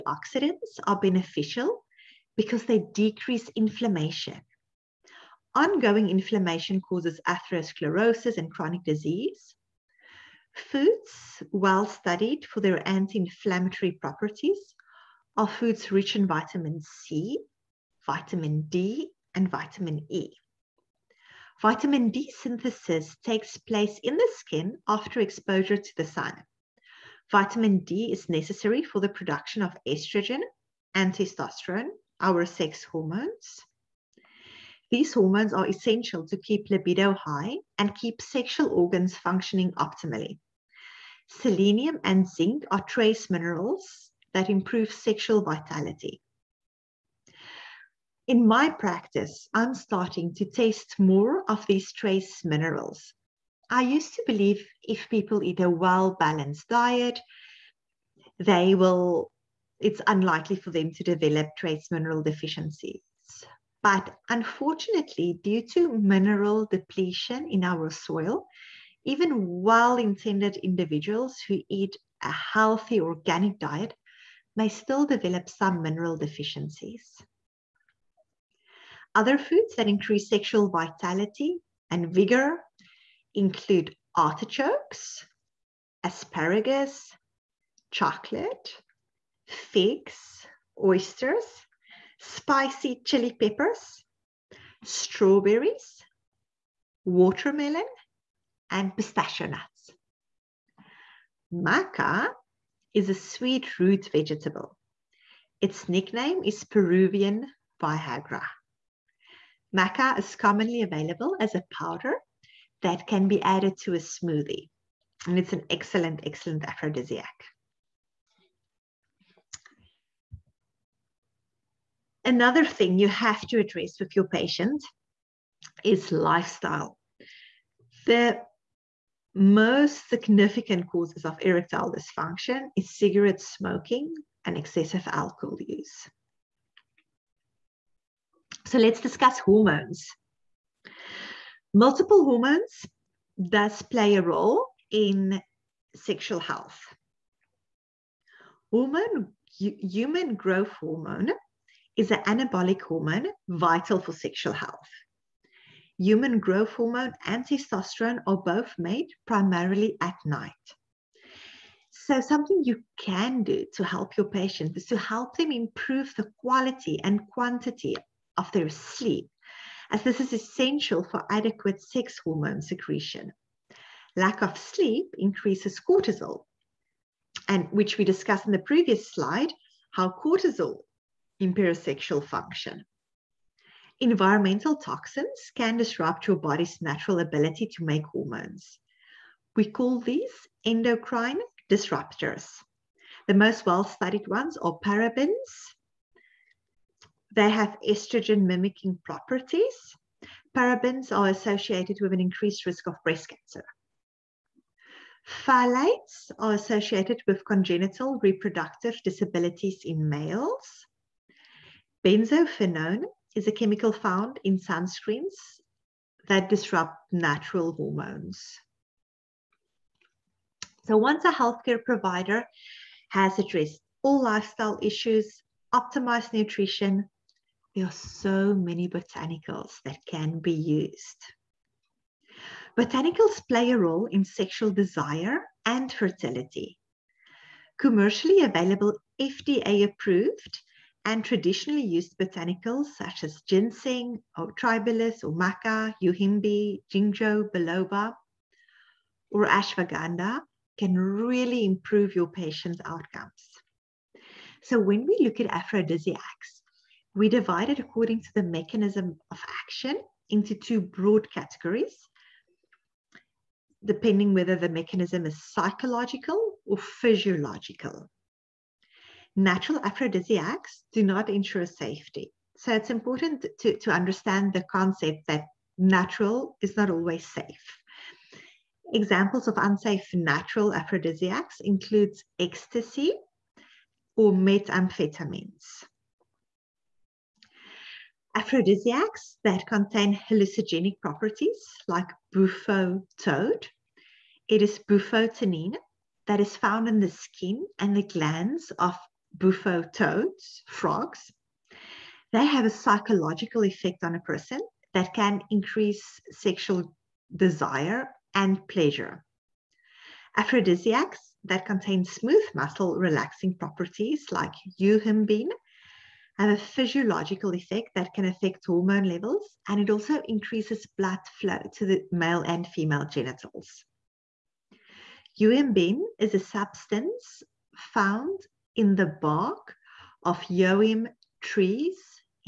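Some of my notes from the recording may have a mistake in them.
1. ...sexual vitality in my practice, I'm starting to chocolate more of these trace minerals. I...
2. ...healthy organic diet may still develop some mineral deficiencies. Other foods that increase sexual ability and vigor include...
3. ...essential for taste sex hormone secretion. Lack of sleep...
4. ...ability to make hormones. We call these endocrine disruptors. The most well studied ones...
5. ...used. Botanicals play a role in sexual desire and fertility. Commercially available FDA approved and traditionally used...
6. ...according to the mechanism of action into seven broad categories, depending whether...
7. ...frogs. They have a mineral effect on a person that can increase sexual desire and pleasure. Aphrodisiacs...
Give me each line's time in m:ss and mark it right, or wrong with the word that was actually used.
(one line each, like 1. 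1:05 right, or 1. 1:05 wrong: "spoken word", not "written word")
1. 0:44 wrong: "taste", not "chocolate"
2. 1:12 wrong: "vitality", not "ability"
3. 2:50 wrong: "adequate", not "taste"
4. 3:07 right
5. 3:50 right
6. 4:17 wrong: "two", not "seven"
7. 5:00 wrong: "psychological", not "mineral".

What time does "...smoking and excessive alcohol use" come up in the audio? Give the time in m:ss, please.
2:13.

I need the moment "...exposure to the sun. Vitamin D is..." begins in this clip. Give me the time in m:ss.
0:25.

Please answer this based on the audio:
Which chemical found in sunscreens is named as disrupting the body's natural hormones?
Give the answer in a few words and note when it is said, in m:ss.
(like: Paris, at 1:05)
Benzophenone, at 3:32.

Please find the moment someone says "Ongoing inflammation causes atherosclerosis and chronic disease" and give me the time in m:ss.
0:05.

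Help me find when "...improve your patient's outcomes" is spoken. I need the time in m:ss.
4:11.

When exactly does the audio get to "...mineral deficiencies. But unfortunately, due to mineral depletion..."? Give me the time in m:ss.
1:01.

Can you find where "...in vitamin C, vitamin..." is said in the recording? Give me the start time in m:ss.
0:16.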